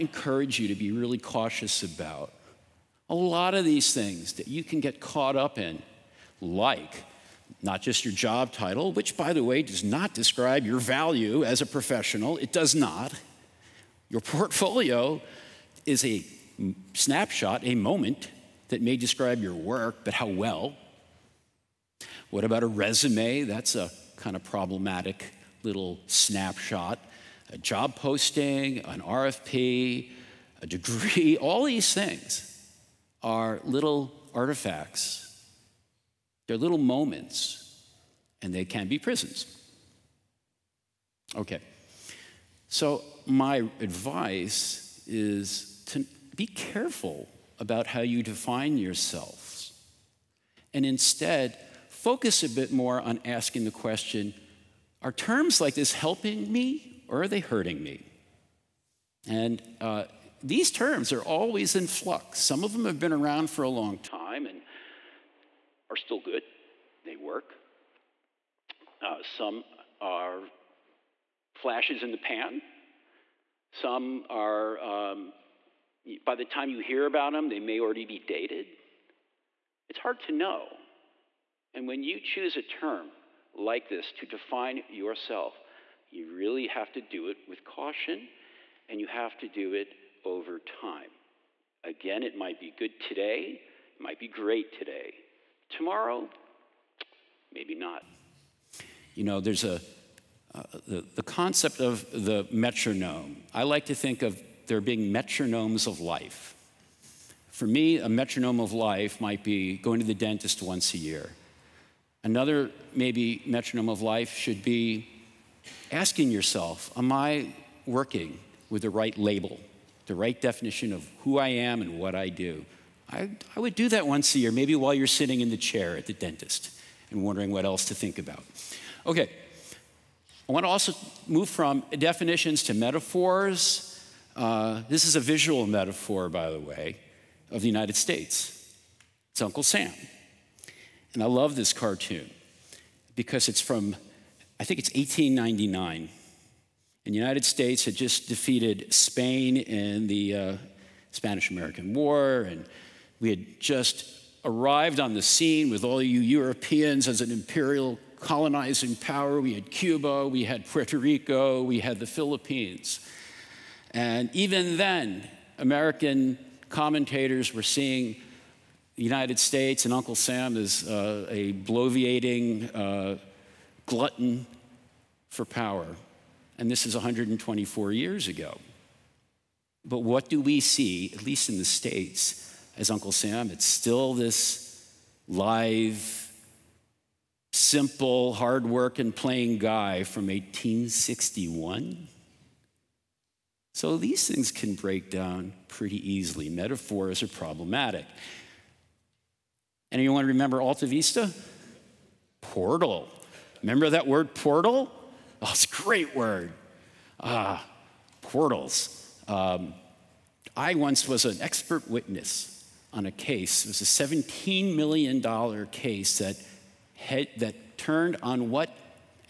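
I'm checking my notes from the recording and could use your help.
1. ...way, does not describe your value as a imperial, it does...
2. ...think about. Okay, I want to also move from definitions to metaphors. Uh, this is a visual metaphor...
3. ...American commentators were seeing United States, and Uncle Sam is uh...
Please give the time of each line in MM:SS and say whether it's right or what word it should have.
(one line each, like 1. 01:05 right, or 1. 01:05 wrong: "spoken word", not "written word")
1. 00:09 wrong: "professional", not "imperial"
2. 02:07 right
3. 02:45 right.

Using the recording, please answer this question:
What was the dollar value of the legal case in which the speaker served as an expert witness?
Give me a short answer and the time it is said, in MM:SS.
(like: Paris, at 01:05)
$17 million, at 03:34.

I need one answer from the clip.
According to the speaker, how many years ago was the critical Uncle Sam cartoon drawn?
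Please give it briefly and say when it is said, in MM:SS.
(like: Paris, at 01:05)
124, at 02:56.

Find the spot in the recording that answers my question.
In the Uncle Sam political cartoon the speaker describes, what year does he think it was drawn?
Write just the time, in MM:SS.
02:24.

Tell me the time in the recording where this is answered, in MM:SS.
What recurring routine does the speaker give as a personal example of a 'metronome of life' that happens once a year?
01:49.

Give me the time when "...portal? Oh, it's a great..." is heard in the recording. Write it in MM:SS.
03:24.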